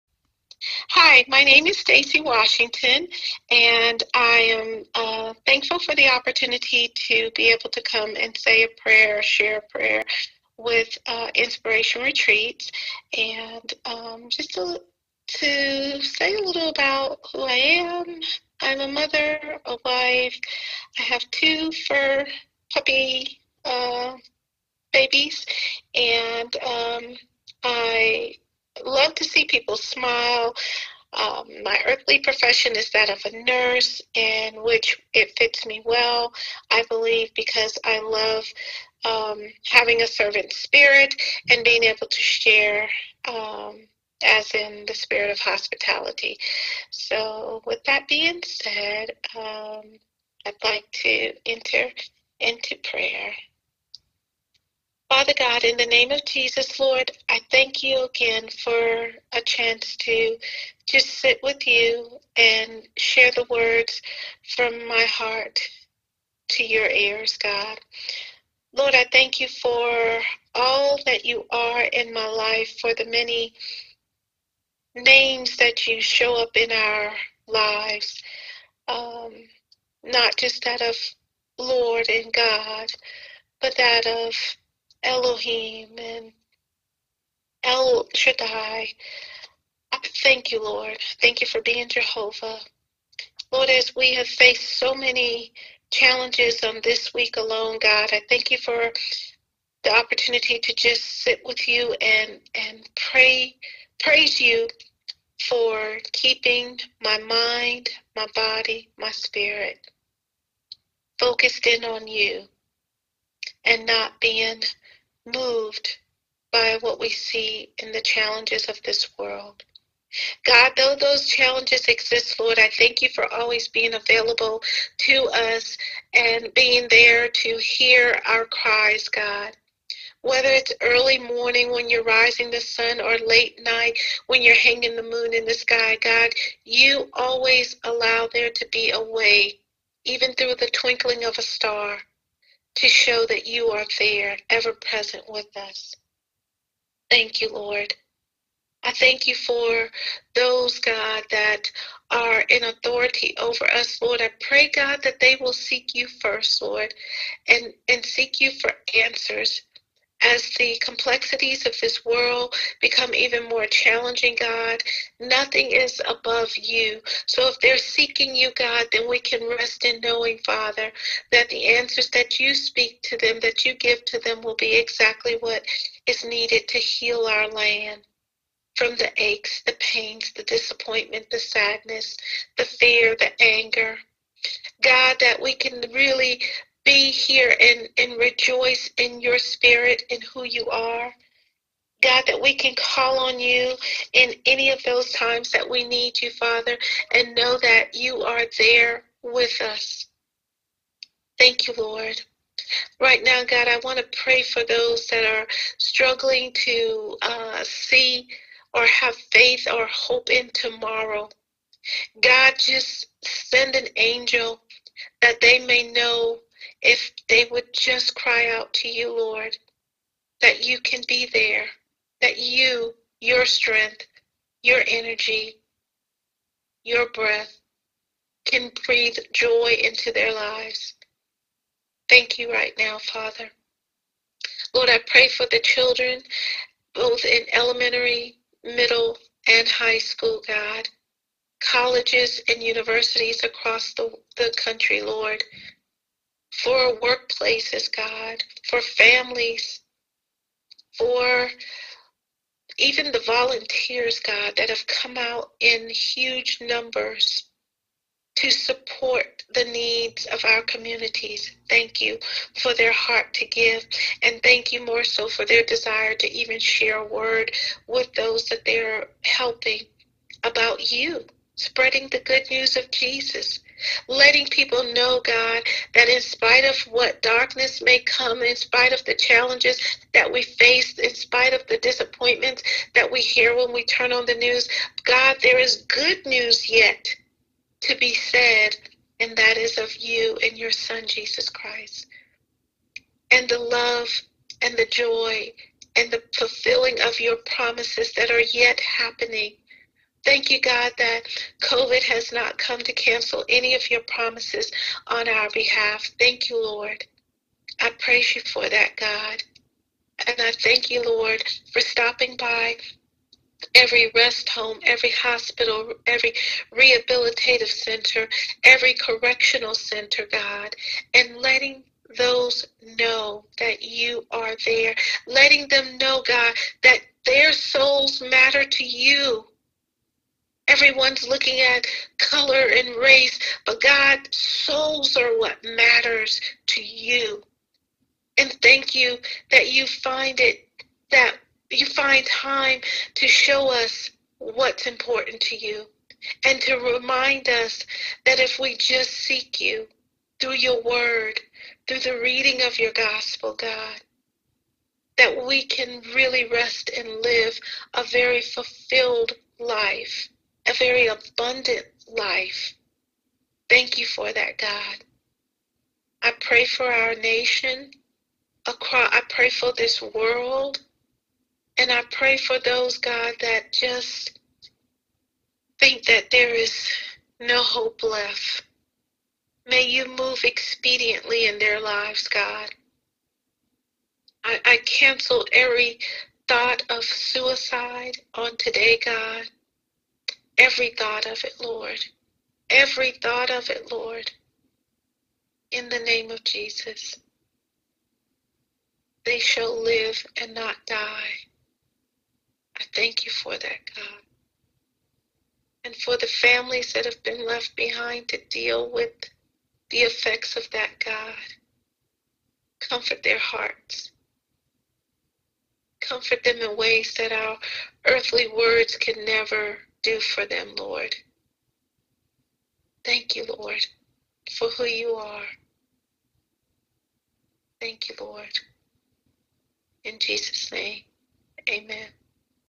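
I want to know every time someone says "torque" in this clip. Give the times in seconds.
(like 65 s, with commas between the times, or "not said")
not said.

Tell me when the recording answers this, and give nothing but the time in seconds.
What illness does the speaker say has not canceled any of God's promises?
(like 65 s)
301 s.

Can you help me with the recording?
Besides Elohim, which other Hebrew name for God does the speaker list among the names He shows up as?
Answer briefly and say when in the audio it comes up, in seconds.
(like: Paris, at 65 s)
El Shaddai, at 87 s.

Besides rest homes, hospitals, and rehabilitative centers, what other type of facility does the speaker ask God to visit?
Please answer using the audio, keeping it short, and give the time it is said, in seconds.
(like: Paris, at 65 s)
Correctional center, at 318 s.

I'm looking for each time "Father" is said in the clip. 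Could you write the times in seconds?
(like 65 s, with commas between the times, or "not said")
55 s, 170 s, 196 s, 232 s.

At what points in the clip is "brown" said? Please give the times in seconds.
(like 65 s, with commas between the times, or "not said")
not said.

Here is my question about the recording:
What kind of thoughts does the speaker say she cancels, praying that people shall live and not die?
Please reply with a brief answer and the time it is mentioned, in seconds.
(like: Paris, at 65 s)
Suicide, at 387 s.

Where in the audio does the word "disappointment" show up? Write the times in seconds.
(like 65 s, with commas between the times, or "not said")
180 s, 281 s.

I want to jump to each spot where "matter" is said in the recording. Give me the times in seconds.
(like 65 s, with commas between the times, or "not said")
328 s, 335 s.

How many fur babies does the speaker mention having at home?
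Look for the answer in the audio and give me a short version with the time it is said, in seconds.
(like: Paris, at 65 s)
2, at 21 s.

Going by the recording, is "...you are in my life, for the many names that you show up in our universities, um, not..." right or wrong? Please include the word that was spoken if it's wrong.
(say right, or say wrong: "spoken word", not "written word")
wrong: "lives", not "universities".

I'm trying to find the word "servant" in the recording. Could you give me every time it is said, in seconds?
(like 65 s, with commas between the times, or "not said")
40 s.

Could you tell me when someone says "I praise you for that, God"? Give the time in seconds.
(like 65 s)
307 s.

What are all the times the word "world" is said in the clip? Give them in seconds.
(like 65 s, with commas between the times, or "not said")
119 s, 162 s, 370 s.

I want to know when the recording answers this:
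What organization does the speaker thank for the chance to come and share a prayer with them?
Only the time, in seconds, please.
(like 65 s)
11 s.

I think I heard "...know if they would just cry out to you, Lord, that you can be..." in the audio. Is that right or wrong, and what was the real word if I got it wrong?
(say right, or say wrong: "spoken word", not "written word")
right.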